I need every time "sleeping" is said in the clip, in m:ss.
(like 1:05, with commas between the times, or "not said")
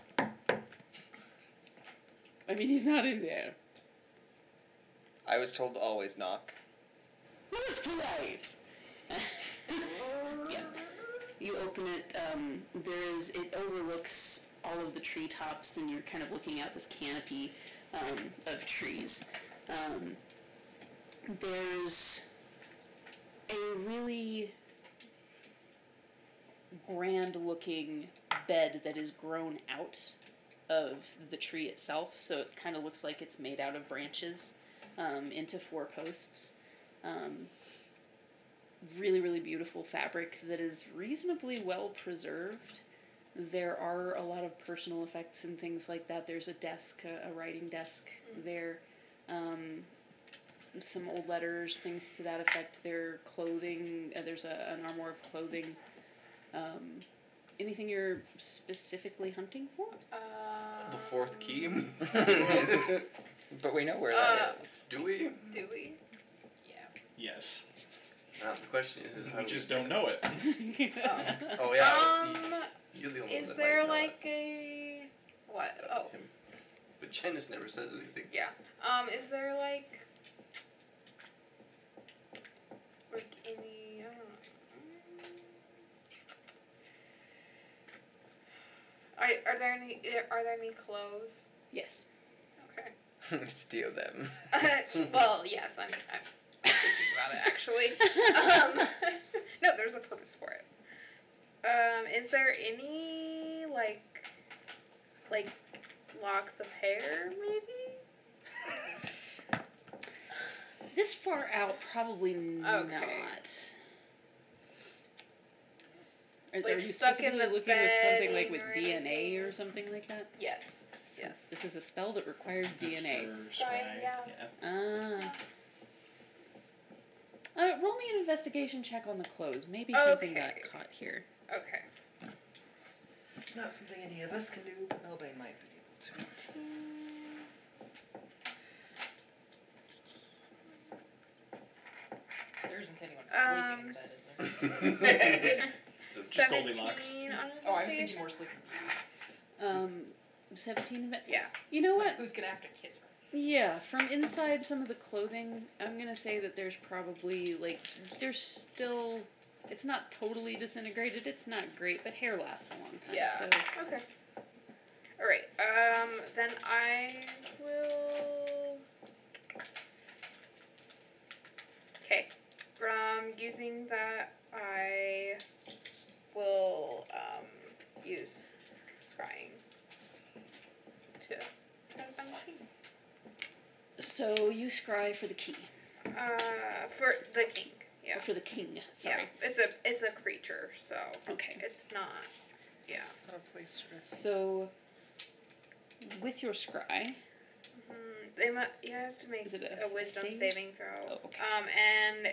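2:23, 2:28.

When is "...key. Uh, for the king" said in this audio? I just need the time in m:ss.
3:05.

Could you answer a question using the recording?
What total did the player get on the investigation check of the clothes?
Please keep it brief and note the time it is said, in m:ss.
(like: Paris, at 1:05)
17, at 2:30.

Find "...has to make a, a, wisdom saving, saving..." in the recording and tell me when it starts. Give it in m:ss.
3:18.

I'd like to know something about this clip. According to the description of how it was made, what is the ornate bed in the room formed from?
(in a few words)
the tree itself.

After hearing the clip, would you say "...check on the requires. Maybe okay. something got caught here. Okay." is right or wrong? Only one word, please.
wrong.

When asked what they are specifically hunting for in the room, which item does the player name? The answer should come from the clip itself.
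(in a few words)
the fourth key.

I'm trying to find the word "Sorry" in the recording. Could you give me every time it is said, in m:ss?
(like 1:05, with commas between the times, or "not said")
2:03, 3:08.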